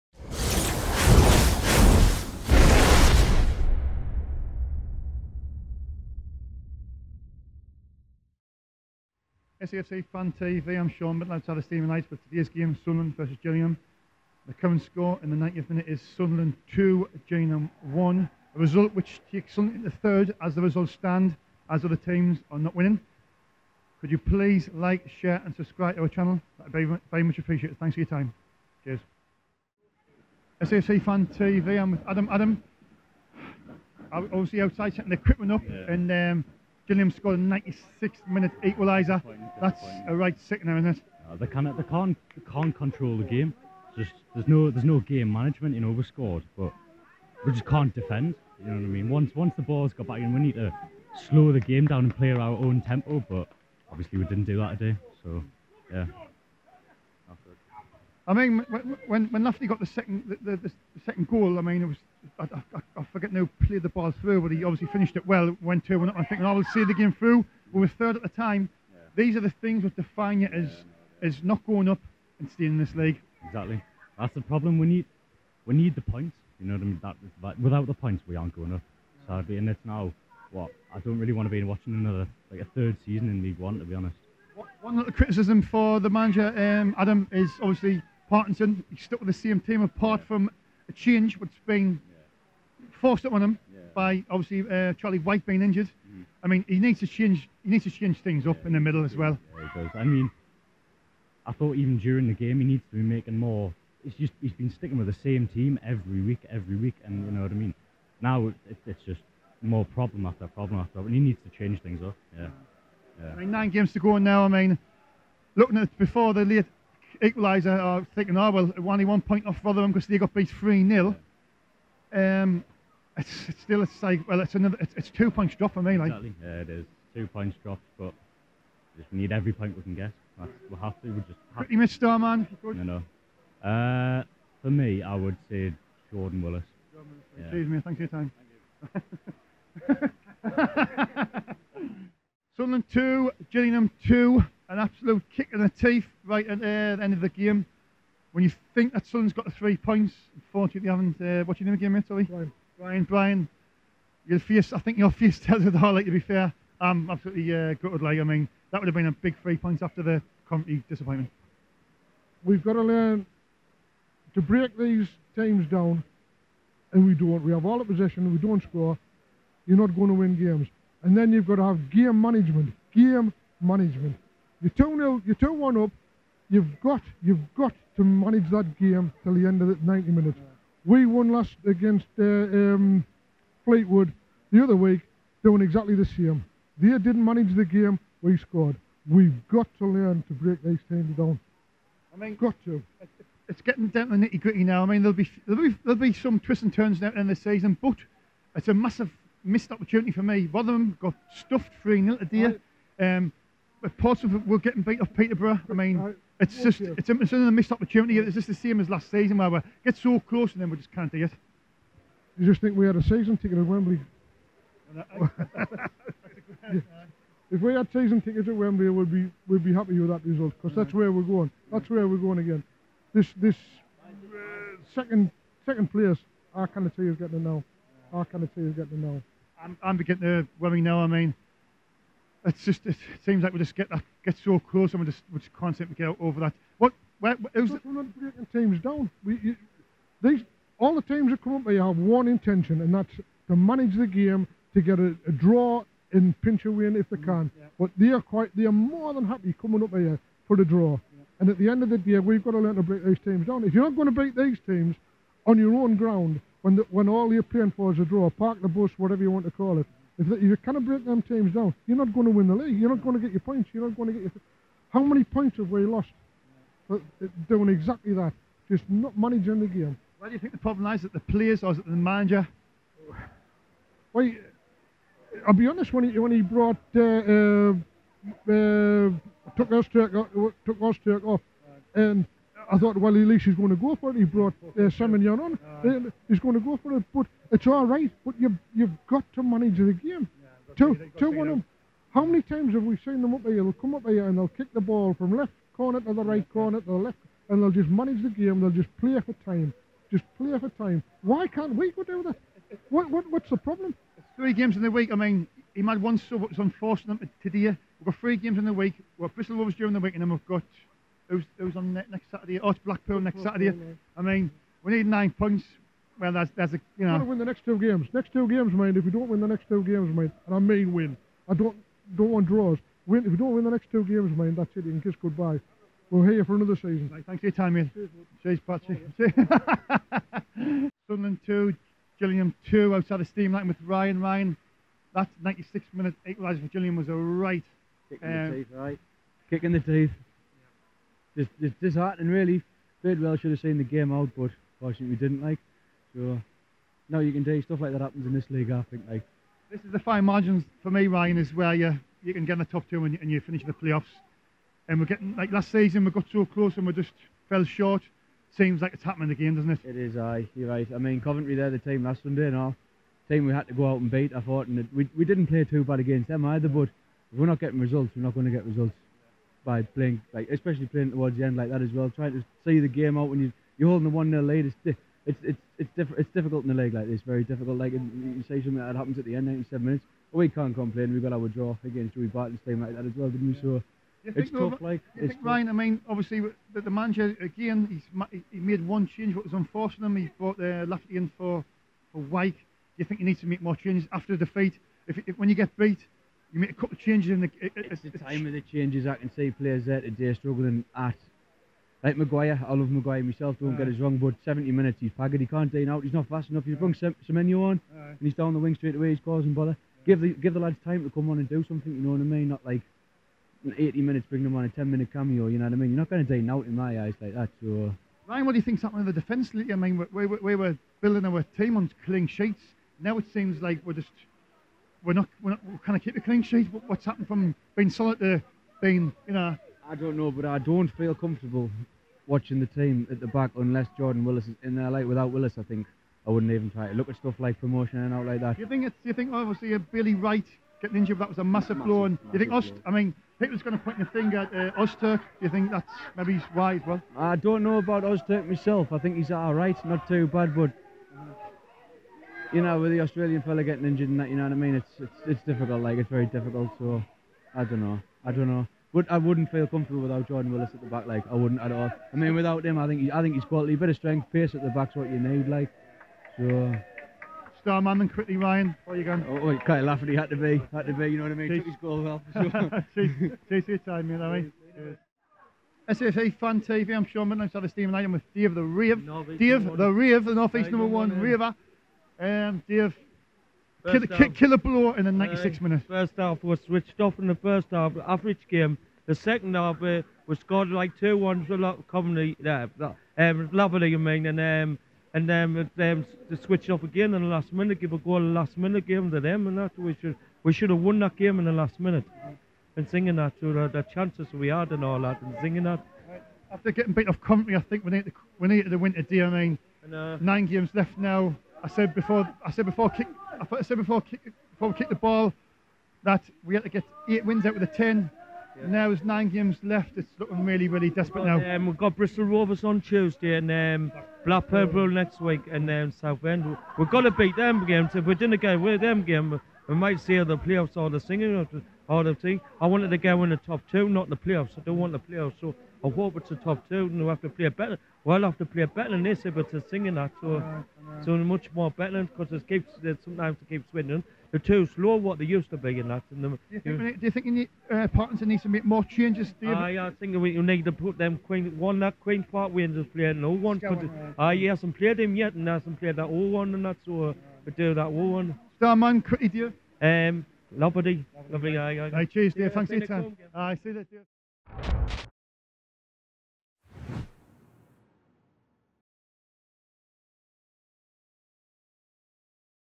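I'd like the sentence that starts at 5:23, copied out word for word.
Win if we don't win the next two games, mate.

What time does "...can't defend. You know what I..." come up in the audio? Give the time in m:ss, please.
0:47.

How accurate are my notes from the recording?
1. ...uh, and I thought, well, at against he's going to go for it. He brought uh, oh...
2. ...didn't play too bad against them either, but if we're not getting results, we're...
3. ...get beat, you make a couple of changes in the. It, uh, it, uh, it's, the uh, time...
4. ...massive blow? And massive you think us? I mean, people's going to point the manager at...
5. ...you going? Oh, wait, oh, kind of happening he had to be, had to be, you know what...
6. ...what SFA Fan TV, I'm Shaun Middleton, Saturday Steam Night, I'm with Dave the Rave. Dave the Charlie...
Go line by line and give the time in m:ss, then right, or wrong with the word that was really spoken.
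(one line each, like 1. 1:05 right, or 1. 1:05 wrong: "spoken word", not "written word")
1. 4:41 wrong: "least", not "against"
2. 6:05 right
3. 6:35 right
4. 7:21 wrong: "finger", not "manager"
5. 7:48 wrong: "laughing", not "happening"
6. 7:55 wrong: "Rave", not "Charlie".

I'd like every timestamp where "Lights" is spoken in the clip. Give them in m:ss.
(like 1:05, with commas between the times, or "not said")
0:11.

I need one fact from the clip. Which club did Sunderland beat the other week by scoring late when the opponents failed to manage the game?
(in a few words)
Fleetwood.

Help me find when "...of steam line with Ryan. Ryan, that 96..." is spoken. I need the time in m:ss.
5:33.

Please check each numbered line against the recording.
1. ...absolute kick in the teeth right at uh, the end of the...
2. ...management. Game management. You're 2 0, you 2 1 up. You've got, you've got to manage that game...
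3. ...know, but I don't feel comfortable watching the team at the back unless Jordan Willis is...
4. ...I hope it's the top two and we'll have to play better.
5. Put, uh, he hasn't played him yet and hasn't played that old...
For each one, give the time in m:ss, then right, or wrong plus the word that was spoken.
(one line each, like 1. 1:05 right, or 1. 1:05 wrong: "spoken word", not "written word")
1. 2:24 right
2. 2:52 right
3. 7:10 right
4. 8:55 right
5. 9:13 right.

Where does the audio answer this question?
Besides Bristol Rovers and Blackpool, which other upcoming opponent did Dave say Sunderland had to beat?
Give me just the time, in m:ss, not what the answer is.
8:45.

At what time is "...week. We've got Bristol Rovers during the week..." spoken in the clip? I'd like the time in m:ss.
5:08.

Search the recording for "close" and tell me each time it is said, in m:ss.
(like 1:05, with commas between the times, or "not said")
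3:30, 3:54, 5:56.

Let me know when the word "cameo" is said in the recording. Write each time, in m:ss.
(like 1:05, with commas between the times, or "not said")
6:55.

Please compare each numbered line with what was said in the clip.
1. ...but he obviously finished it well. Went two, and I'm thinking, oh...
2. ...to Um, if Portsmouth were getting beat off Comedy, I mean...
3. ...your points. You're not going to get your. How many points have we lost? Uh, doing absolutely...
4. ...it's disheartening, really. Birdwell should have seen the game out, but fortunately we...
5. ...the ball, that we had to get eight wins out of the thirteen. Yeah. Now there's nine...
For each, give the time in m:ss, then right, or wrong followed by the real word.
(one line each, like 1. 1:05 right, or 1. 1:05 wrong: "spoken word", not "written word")
1. 1:04 right
2. 3:22 wrong: "Peterborough", not "Comedy"
3. 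4:23 wrong: "exactly", not "absolutely"
4. 5:41 right
5. 8:34 wrong: "ten", not "thirteen".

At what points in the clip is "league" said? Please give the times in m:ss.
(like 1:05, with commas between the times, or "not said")
1:12, 1:23, 4:22, 5:48, 6:16.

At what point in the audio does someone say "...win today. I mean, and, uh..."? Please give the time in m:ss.
8:28.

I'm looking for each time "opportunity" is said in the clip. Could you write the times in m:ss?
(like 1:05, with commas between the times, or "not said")
3:19, 3:27.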